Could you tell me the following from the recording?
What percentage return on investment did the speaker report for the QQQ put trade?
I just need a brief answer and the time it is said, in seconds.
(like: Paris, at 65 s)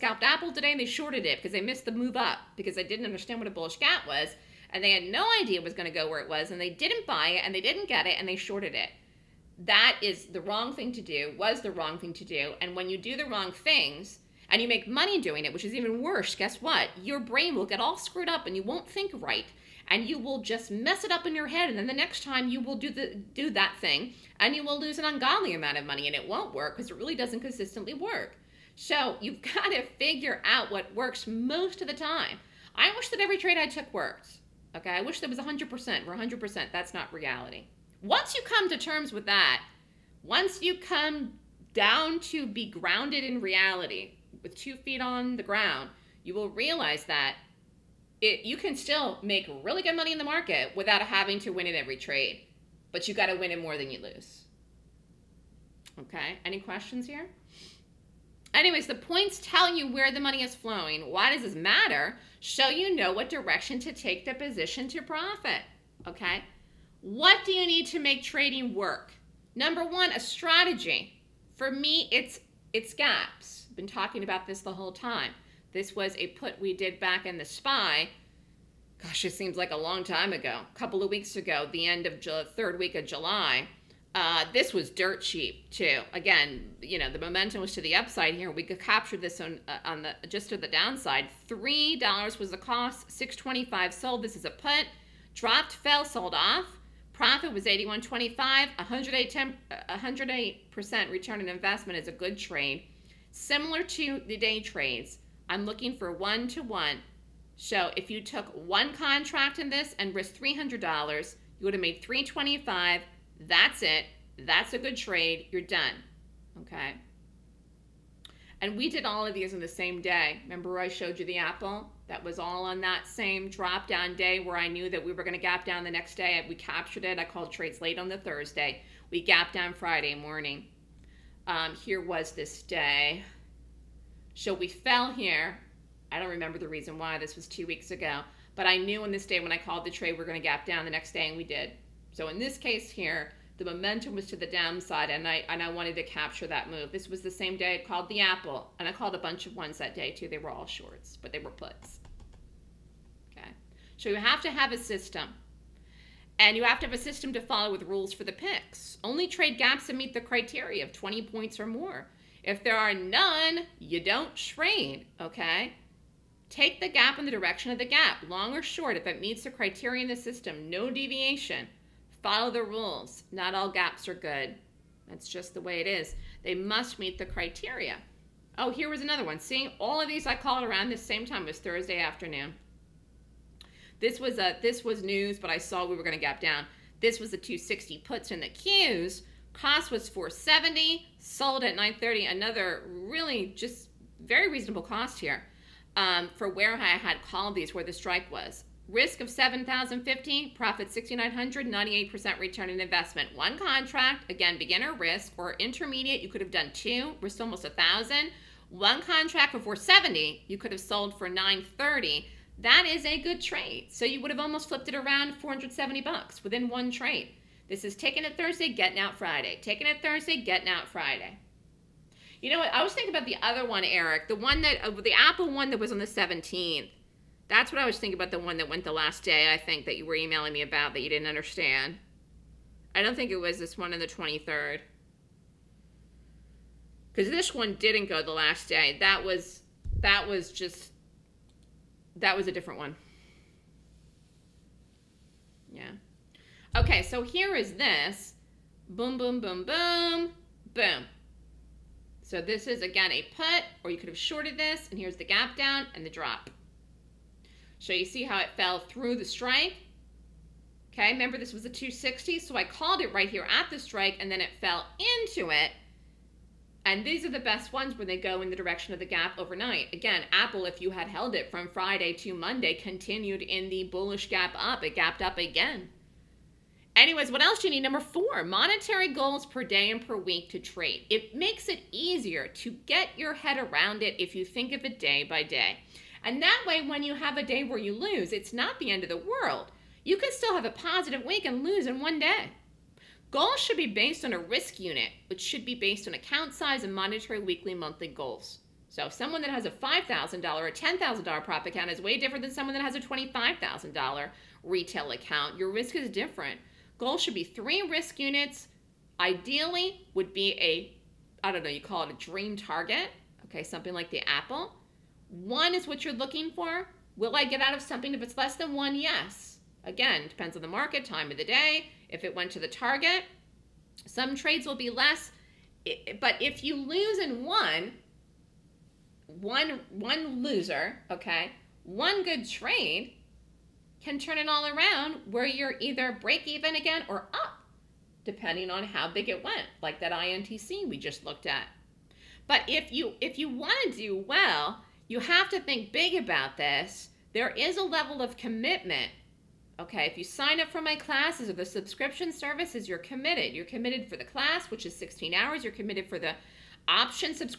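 98%, at 201 s.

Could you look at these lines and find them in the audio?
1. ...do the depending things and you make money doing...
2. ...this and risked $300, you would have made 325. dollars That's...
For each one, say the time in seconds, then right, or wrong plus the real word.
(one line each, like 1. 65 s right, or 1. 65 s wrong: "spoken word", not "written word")
1. 12 s wrong: "wrong", not "depending"
2. 109 s right.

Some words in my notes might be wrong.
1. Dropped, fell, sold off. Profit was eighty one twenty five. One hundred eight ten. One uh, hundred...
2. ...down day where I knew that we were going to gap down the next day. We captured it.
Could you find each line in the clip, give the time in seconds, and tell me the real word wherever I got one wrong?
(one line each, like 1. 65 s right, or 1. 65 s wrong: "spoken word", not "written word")
1. 95 s right
2. 123 s right.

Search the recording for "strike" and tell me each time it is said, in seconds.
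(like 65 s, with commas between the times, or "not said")
197 s, 259 s, 263 s.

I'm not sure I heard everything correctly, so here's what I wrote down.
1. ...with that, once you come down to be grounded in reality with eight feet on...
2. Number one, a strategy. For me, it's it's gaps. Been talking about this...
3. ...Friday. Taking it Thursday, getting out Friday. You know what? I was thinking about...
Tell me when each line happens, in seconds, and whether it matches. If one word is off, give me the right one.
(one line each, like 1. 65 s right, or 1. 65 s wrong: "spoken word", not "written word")
1. 39 s wrong: "two", not "eight"
2. 69 s right
3. 219 s right.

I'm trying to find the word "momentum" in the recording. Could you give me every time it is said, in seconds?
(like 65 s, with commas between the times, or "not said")
87 s, 143 s.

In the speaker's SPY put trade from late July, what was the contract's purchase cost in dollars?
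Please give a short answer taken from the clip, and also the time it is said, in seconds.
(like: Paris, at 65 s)
$3, at 91 s.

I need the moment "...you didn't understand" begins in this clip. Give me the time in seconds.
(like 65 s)
231 s.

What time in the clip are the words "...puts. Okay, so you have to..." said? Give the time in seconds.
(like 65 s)
151 s.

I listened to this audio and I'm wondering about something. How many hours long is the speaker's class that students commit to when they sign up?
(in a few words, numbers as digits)
16 hours.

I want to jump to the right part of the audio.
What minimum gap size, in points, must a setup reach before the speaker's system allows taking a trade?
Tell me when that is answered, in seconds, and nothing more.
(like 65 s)
160 s.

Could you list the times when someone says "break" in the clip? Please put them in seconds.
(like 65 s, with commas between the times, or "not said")
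336 s.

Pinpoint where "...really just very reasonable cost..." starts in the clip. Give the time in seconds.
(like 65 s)
192 s.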